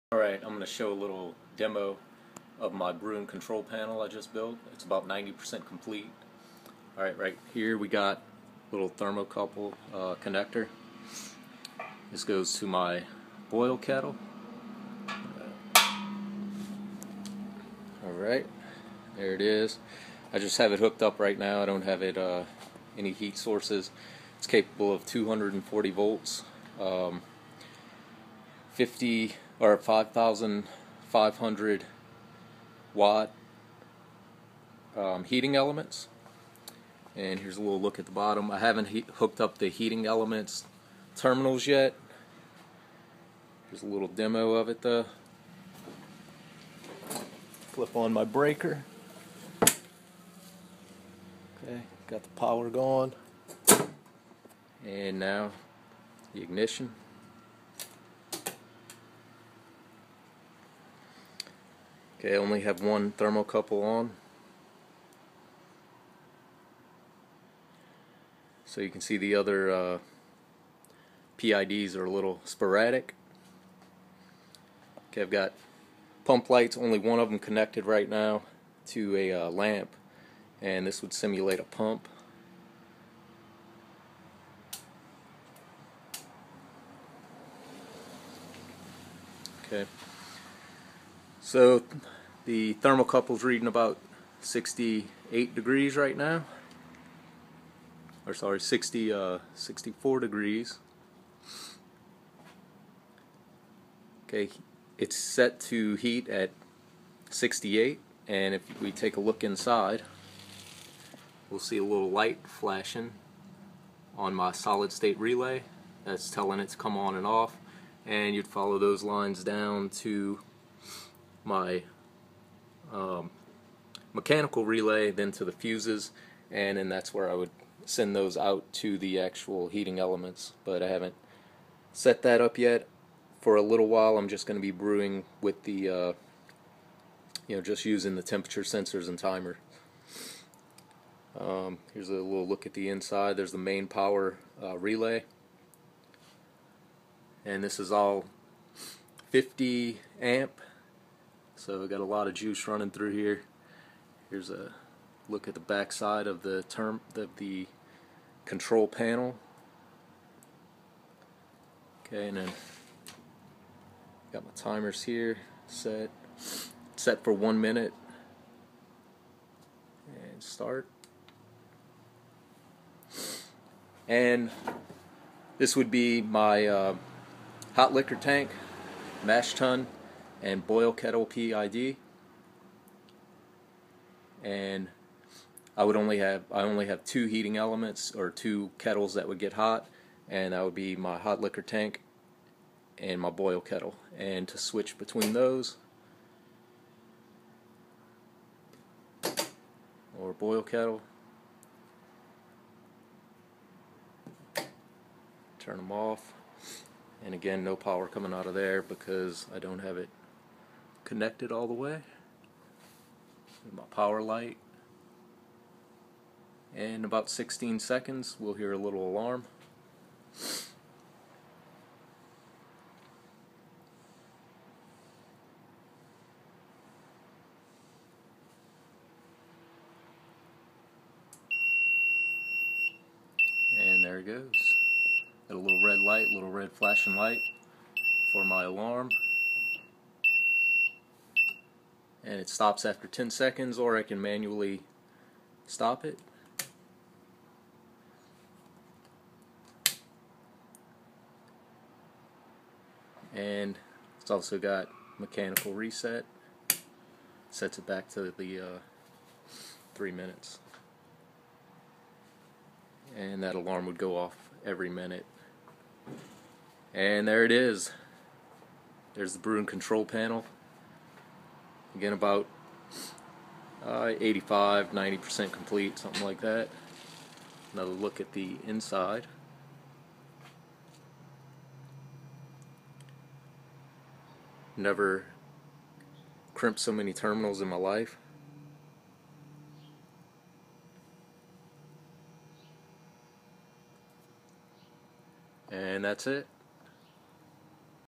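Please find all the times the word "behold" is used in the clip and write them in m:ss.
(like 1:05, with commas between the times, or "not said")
not said.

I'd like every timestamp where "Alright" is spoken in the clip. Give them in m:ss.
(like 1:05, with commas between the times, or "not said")
0:00, 0:06, 0:18.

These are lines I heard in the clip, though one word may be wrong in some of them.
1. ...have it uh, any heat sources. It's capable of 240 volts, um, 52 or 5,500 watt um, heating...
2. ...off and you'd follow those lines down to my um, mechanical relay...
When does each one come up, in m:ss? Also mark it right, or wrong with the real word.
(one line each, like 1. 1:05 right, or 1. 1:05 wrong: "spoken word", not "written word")
1. 0:21 wrong: "50", not "52"
2. 1:57 right.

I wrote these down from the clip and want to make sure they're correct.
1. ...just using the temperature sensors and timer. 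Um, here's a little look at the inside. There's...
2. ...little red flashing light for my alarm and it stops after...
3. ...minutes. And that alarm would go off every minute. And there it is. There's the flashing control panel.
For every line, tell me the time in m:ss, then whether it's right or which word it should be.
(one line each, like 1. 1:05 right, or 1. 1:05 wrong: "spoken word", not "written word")
1. 2:17 right
2. 3:56 right
3. 4:20 wrong: "brewing", not "flashing".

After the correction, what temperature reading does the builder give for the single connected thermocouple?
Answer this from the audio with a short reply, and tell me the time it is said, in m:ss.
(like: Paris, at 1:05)
64 degrees, at 1:39.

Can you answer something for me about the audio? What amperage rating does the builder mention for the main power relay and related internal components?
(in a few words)
50 amp.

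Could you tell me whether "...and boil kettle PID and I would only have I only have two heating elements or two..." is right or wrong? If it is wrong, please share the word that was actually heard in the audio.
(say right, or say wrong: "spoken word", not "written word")
right.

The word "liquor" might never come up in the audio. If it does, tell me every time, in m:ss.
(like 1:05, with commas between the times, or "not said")
2:57, 3:11.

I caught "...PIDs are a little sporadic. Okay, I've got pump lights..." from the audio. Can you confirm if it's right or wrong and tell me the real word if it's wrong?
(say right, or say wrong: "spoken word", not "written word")
right.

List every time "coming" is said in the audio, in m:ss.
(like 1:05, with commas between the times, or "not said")
3:28.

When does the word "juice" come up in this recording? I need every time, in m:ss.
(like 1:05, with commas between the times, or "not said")
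2:32.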